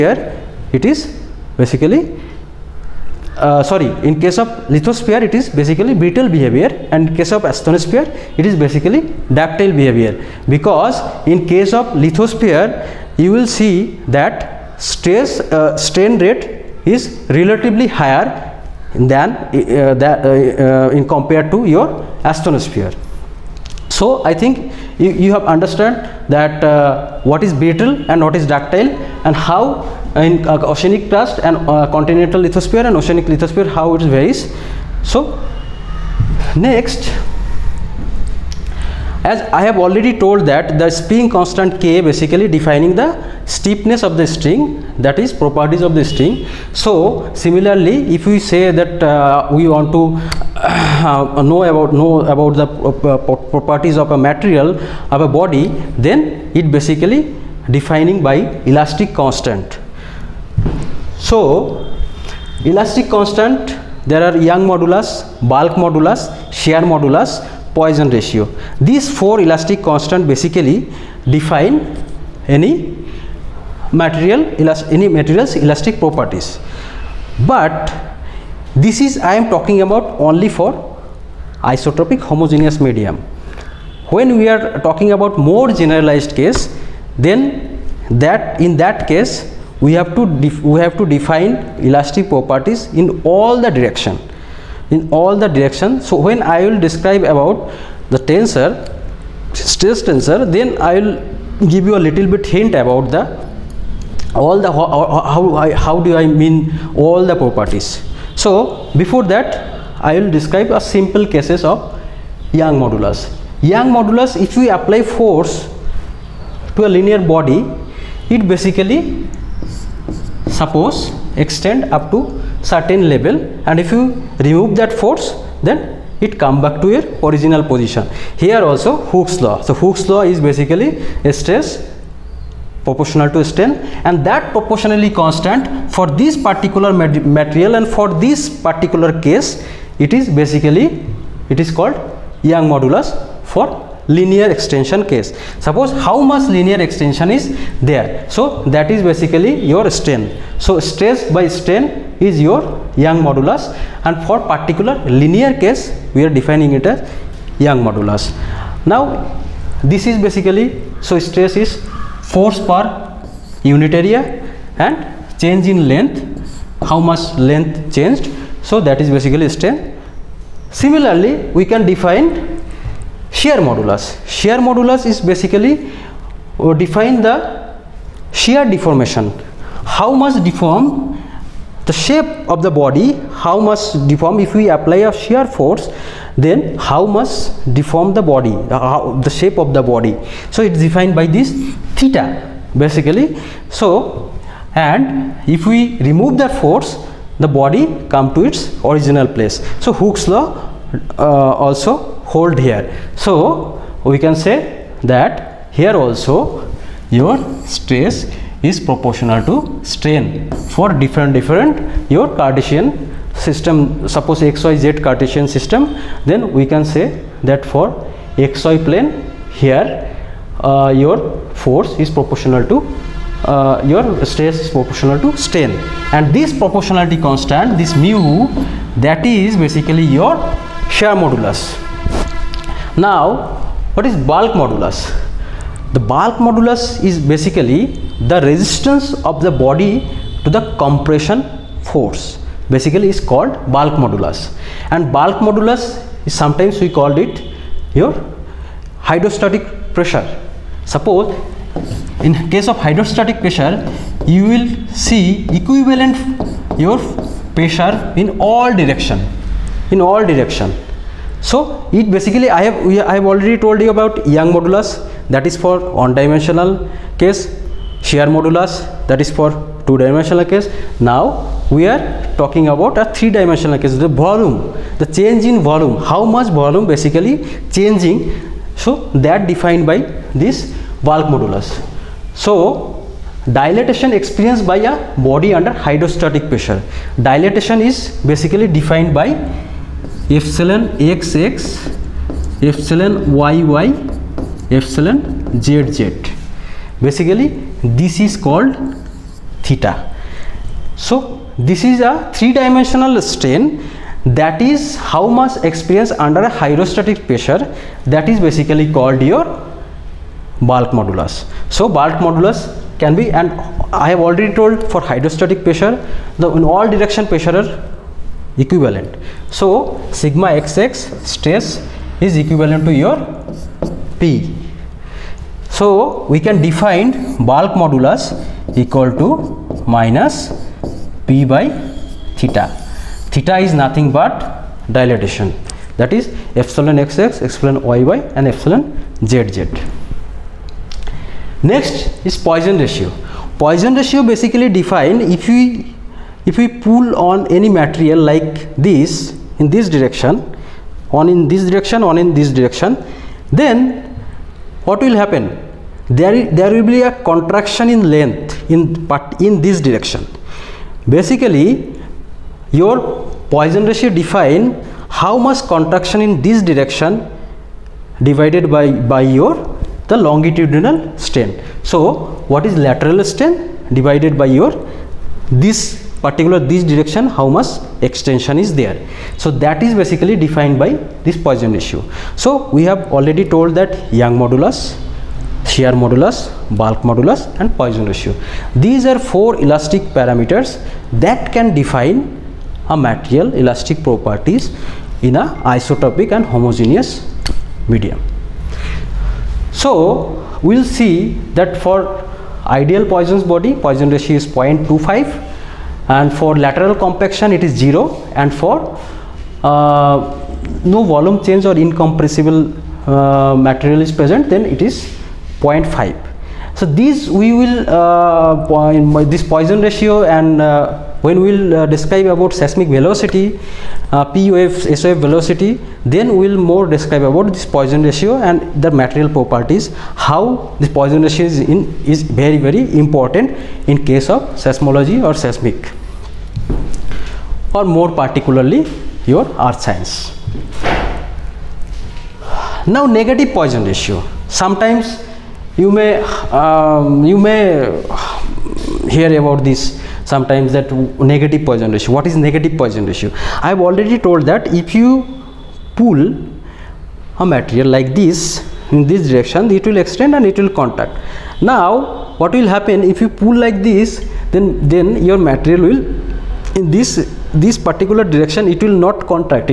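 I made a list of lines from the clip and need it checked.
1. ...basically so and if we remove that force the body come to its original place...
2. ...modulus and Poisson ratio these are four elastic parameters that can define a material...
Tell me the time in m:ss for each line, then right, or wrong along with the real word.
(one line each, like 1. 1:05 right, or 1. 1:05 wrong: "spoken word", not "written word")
1. 3:12 right
2. 6:27 right.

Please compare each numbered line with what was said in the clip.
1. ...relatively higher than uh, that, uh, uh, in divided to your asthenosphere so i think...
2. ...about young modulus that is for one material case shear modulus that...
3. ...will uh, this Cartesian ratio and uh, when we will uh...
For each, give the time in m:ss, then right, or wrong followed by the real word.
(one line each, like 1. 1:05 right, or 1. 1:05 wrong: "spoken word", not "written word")
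1. 0:17 wrong: "compared", not "divided"
2. 4:23 wrong: "dimensional", not "material"
3. 6:57 wrong: "Poisson", not "Cartesian".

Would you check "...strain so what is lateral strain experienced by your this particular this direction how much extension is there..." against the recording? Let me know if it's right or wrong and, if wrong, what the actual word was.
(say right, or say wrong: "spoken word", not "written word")
wrong: "divided", not "experienced".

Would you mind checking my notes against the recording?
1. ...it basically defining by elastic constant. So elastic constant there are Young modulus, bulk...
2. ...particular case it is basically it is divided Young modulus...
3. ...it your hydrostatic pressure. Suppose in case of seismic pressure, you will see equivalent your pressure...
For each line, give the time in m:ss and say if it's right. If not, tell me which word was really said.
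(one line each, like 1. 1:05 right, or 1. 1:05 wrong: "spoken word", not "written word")
1. 0:56 right
2. 2:18 wrong: "called", not "divided"
3. 4:07 wrong: "hydrostatic", not "seismic".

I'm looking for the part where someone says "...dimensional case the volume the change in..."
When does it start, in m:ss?
4:33.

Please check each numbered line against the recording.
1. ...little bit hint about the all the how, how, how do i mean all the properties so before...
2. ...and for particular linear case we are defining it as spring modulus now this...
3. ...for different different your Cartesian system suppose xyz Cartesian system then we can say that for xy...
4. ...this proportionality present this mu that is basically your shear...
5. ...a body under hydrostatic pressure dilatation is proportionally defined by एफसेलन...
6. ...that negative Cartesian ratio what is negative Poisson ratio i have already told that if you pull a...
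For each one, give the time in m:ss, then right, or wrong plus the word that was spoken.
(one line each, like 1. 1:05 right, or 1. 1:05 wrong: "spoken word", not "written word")
1. 1:42 right
2. 2:34 wrong: "young", not "spring"
3. 3:30 right
4. 3:46 wrong: "constant", not "present"
5. 4:44 wrong: "basically", not "proportionally"
6. 7:30 wrong: "Poisson", not "Cartesian".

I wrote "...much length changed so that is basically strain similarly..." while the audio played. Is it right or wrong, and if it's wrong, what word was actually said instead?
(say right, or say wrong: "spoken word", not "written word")
right.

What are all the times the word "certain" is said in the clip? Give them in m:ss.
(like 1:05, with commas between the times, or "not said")
2:02.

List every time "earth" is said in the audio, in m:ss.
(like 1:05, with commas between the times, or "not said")
7:19.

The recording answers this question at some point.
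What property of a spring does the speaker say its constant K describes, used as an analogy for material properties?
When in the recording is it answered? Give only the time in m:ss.
0:43.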